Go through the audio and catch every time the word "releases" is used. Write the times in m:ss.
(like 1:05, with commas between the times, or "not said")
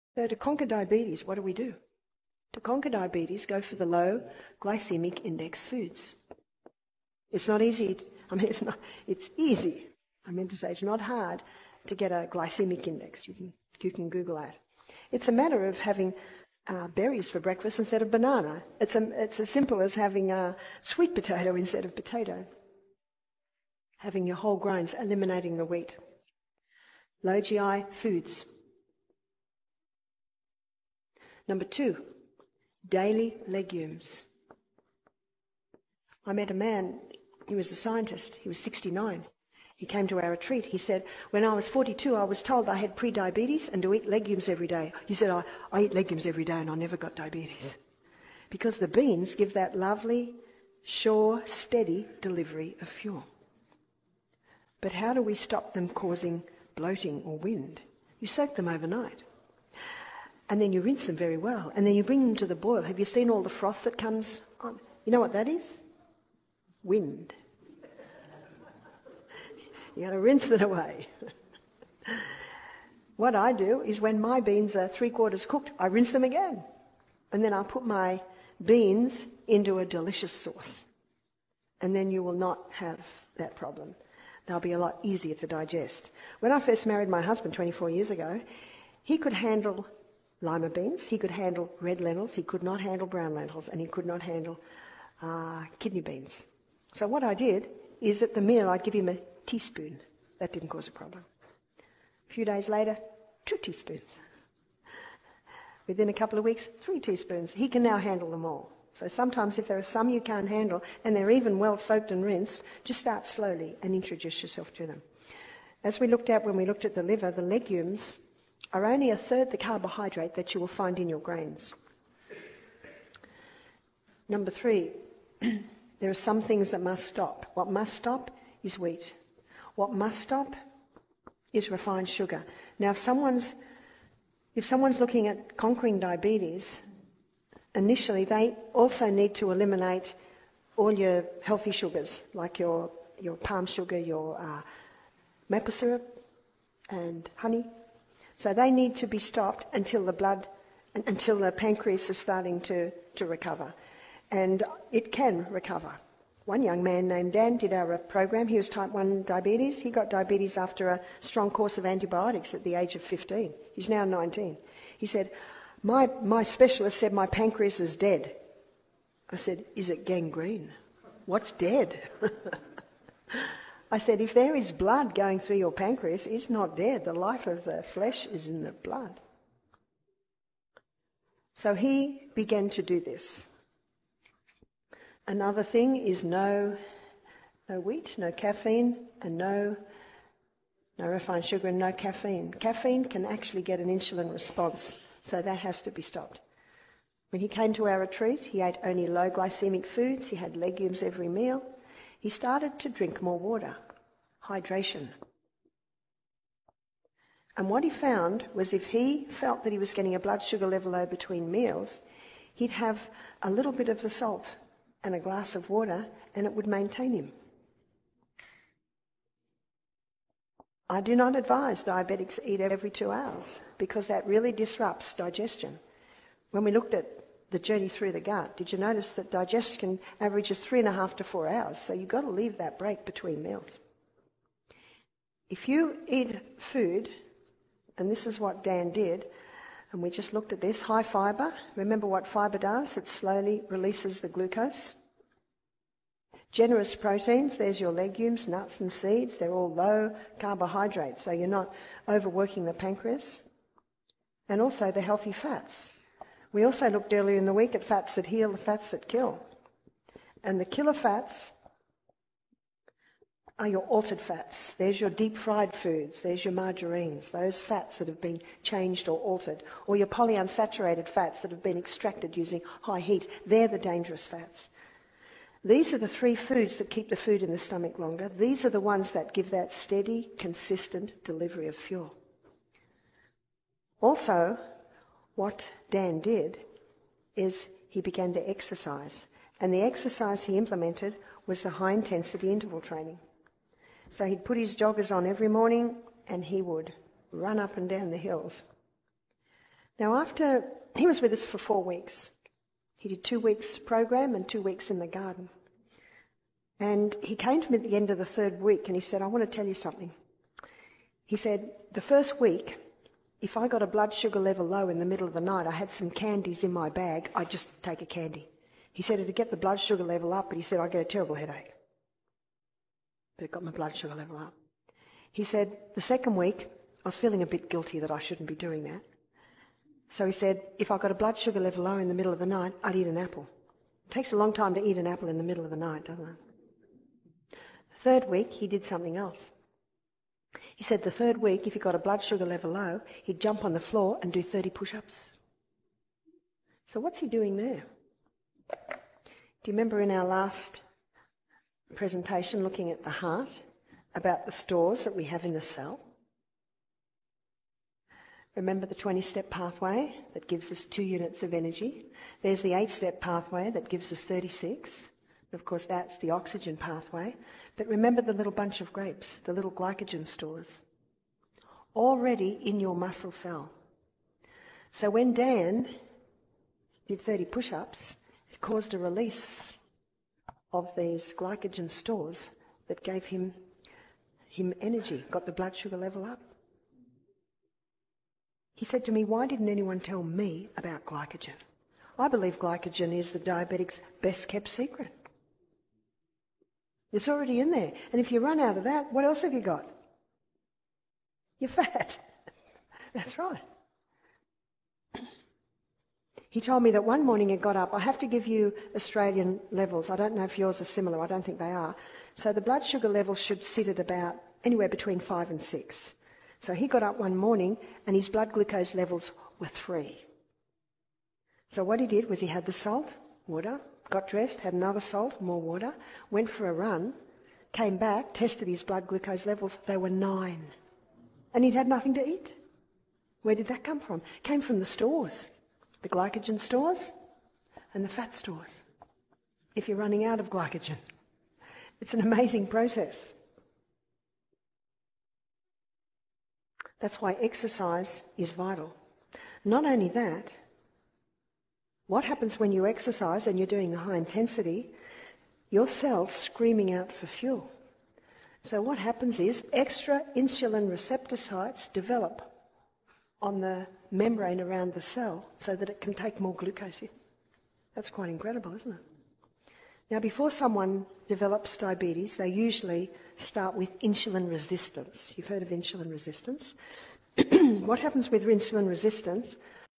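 4:03, 6:18.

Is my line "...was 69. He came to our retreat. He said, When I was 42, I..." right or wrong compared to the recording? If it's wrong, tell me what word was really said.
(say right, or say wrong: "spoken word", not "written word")
right.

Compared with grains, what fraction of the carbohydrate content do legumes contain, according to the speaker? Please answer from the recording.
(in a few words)
a third.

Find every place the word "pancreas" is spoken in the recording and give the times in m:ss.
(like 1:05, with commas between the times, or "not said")
2:31, 2:47, 2:55, 4:12.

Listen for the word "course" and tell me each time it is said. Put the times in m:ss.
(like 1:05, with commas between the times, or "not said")
2:41, 6:05.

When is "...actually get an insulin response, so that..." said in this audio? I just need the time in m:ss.
3:13.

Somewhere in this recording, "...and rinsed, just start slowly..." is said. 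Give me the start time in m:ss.
1:52.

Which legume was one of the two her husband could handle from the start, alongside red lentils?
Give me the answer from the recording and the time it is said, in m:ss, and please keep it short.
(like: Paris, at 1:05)
lima beans, at 1:30.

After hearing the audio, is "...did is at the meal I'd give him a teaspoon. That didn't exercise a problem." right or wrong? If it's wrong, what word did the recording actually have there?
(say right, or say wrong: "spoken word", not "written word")
wrong: "cause", not "exercise".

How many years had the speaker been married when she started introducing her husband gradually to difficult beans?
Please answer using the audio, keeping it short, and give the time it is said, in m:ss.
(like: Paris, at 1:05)
24, at 1:27.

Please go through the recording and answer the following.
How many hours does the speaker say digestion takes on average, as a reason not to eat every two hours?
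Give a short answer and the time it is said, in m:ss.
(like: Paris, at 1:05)
3.5 to 4 hours, at 3:50.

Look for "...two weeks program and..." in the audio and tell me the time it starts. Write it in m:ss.
5:03.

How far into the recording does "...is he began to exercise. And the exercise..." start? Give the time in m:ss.
4:47.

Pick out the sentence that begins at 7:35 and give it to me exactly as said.
Your cell's screaming out for fuel.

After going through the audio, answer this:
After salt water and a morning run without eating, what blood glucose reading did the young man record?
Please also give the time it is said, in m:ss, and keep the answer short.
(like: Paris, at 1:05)
9, at 7:10.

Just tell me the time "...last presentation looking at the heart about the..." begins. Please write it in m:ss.
5:50.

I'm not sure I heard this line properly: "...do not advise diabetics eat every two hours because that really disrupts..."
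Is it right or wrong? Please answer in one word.
right.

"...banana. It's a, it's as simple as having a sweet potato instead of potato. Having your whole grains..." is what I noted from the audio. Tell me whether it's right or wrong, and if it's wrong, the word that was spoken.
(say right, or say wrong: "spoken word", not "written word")
right.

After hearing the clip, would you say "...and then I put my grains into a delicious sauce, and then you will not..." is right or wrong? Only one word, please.
wrong.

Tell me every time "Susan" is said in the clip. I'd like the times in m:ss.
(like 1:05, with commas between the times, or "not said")
not said.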